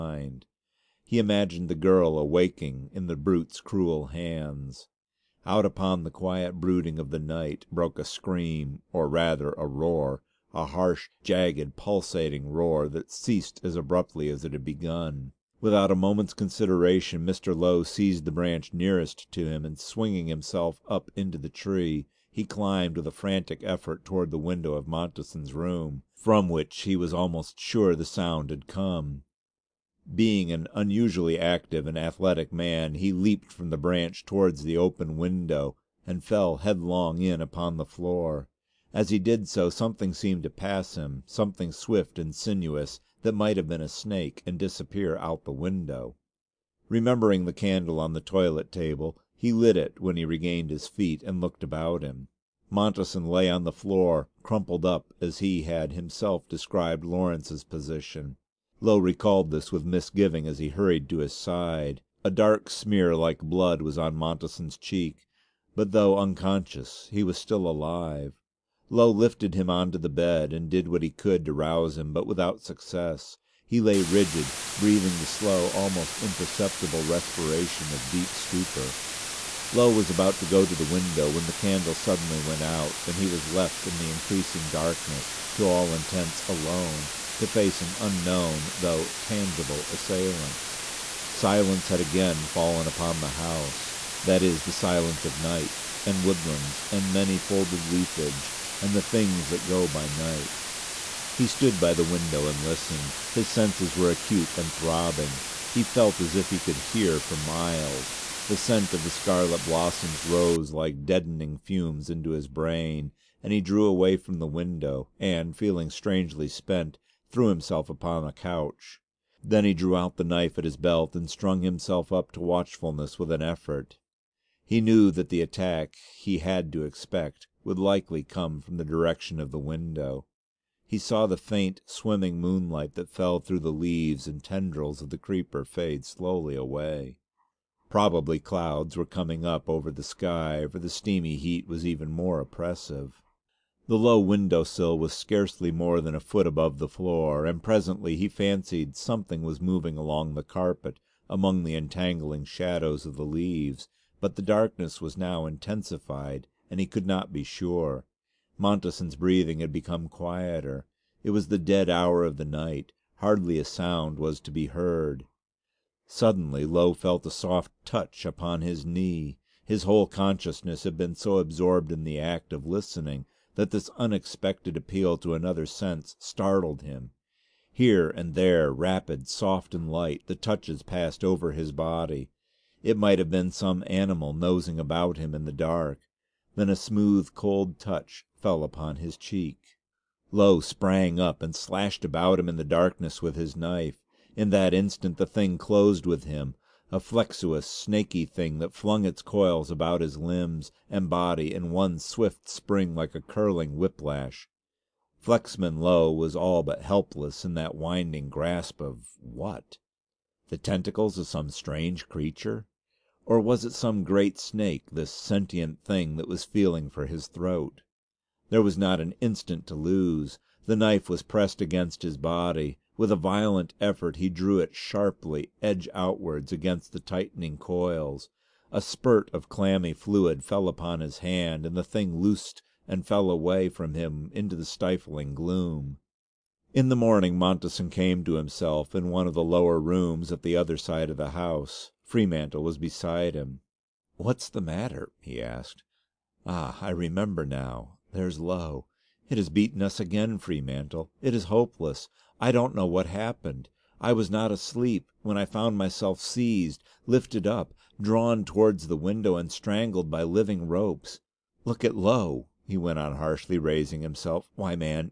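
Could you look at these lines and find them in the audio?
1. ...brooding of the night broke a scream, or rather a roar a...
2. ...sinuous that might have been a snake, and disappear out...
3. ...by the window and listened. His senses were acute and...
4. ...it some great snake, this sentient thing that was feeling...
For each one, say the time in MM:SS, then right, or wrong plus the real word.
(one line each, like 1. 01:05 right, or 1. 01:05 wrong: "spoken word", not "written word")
1. 00:06 right
2. 00:42 right
3. 01:41 right
4. 03:33 right.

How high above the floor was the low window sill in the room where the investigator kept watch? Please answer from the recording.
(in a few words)
a foot.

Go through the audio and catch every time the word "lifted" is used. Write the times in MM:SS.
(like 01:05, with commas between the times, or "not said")
01:09, 04:17.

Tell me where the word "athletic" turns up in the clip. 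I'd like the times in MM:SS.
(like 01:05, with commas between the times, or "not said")
00:31.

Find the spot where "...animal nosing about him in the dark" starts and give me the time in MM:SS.
03:03.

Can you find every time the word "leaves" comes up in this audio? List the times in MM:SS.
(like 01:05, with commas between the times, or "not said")
02:13, 02:33.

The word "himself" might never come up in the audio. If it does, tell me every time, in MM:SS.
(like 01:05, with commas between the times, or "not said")
00:20, 00:55, 01:57, 02:01, 03:58, 04:24.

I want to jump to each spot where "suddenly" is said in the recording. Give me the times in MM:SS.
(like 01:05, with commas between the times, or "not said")
01:21, 02:46.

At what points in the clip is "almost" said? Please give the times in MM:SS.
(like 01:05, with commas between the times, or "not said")
00:27, 01:15.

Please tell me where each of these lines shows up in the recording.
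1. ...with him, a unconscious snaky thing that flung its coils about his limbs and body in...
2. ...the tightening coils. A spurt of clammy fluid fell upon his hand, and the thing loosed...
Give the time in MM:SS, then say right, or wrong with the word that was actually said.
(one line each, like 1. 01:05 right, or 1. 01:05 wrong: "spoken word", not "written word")
1. 03:16 wrong: "flexuous", not "unconscious"
2. 03:46 right.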